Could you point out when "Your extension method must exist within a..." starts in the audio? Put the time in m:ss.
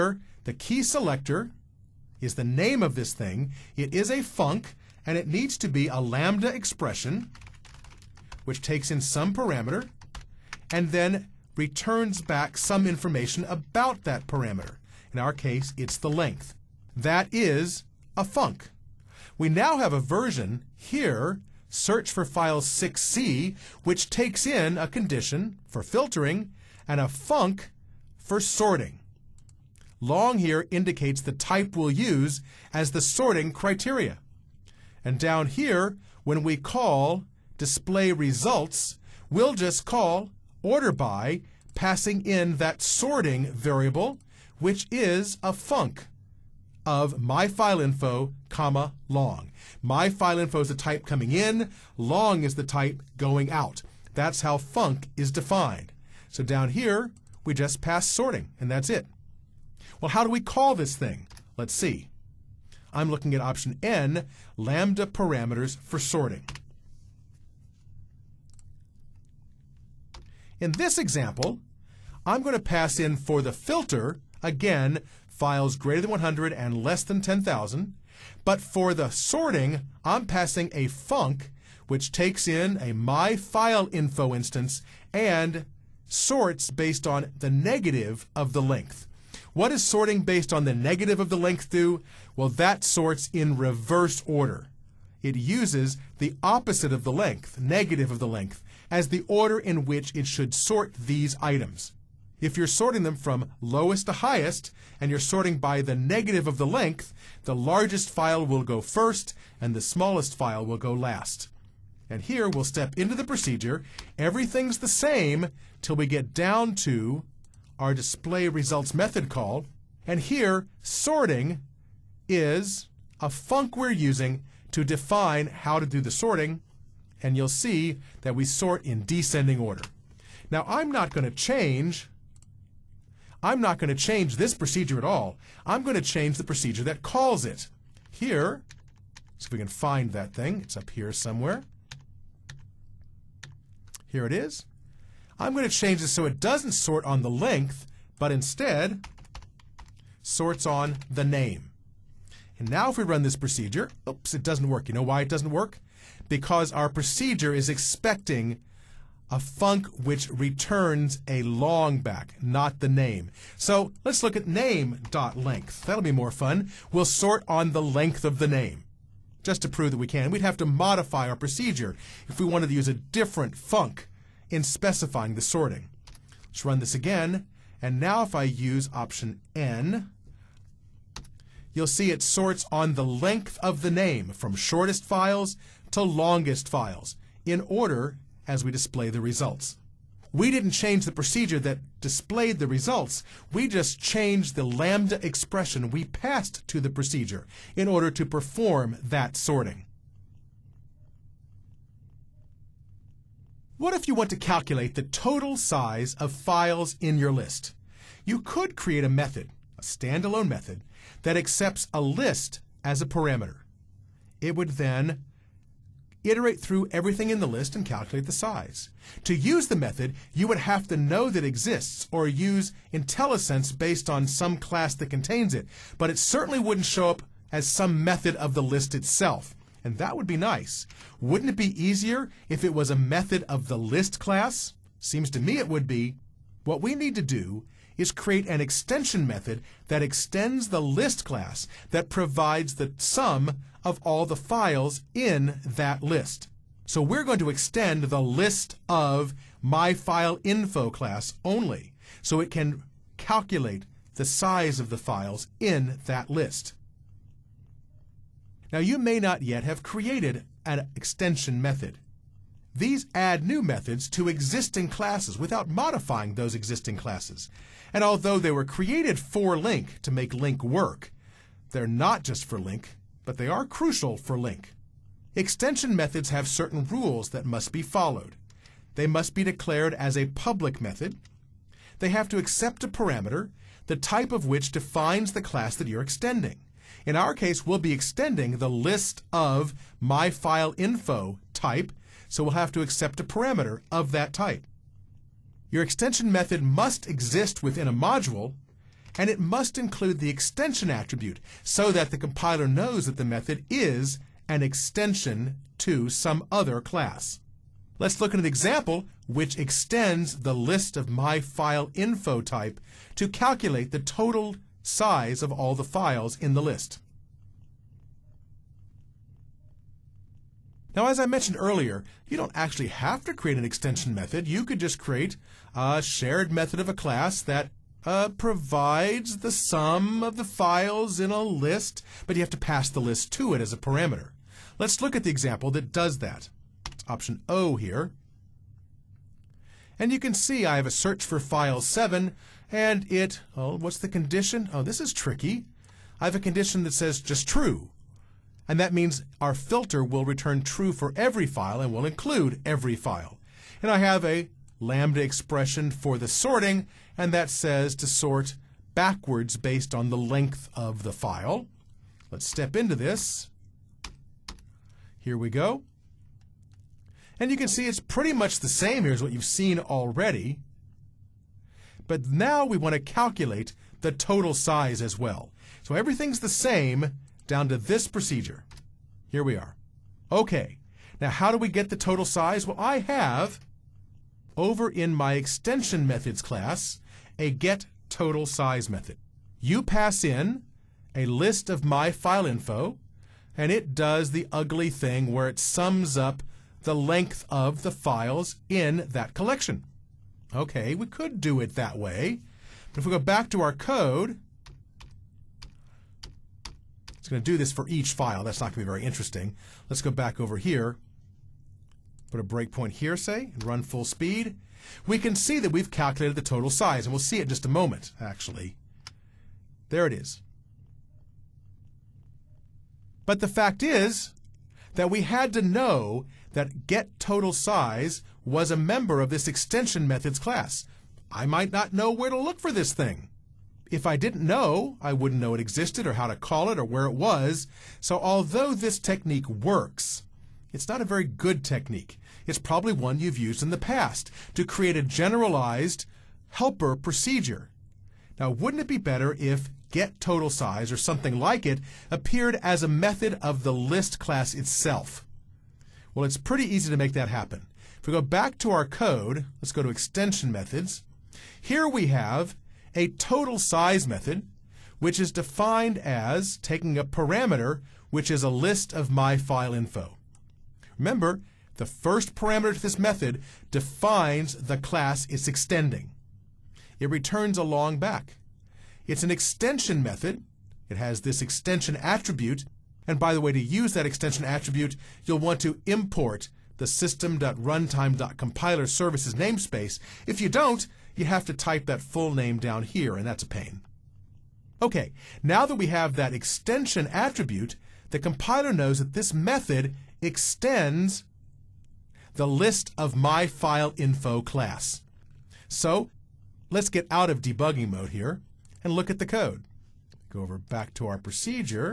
4:55.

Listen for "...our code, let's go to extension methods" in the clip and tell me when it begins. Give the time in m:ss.
7:38.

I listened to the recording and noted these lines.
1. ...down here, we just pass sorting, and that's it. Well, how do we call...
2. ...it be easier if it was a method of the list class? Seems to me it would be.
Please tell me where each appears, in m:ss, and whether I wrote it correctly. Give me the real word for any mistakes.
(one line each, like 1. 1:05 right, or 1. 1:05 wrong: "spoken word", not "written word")
1. 0:56 right
2. 3:51 right.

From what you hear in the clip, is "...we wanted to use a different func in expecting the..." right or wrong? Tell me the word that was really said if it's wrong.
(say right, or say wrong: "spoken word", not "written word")
wrong: "specifying", not "expecting".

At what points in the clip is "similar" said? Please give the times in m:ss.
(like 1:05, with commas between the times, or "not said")
not said.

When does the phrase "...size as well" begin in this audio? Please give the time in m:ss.
6:14.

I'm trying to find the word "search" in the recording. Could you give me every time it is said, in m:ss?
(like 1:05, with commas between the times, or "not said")
0:21, 5:40.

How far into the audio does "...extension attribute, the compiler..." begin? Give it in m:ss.
8:16.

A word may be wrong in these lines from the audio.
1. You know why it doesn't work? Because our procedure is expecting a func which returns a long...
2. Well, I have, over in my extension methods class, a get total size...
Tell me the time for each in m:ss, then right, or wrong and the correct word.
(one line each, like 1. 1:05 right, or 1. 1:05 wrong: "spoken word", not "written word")
1. 2:34 right
2. 6:22 right.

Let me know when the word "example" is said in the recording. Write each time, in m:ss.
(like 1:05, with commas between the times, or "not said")
1:10, 5:08, 5:35.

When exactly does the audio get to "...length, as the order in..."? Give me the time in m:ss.
1:38.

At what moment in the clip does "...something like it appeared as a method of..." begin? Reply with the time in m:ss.
7:30.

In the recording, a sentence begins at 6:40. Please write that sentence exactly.
Okay, we could do it that way.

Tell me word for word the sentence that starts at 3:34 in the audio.
It would then iterate through everything in the list and calculate the size.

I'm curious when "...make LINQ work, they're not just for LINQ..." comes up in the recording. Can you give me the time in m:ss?
4:30.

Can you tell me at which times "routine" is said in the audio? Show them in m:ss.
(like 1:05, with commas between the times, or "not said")
not said.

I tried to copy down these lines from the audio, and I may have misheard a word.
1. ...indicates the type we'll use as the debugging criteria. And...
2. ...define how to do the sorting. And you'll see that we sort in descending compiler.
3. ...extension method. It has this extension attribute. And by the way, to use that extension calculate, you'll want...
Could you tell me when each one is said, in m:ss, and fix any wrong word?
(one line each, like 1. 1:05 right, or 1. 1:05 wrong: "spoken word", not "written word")
1. 0:30 wrong: "sorting", not "debugging"
2. 2:04 wrong: "order", not "compiler"
3. 7:59 wrong: "attribute", not "calculate".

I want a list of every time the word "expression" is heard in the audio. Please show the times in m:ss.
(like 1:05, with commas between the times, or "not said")
0:06, 3:15, 5:55.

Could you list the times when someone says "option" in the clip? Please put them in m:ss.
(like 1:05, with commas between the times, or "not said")
1:03, 2:58, 5:37.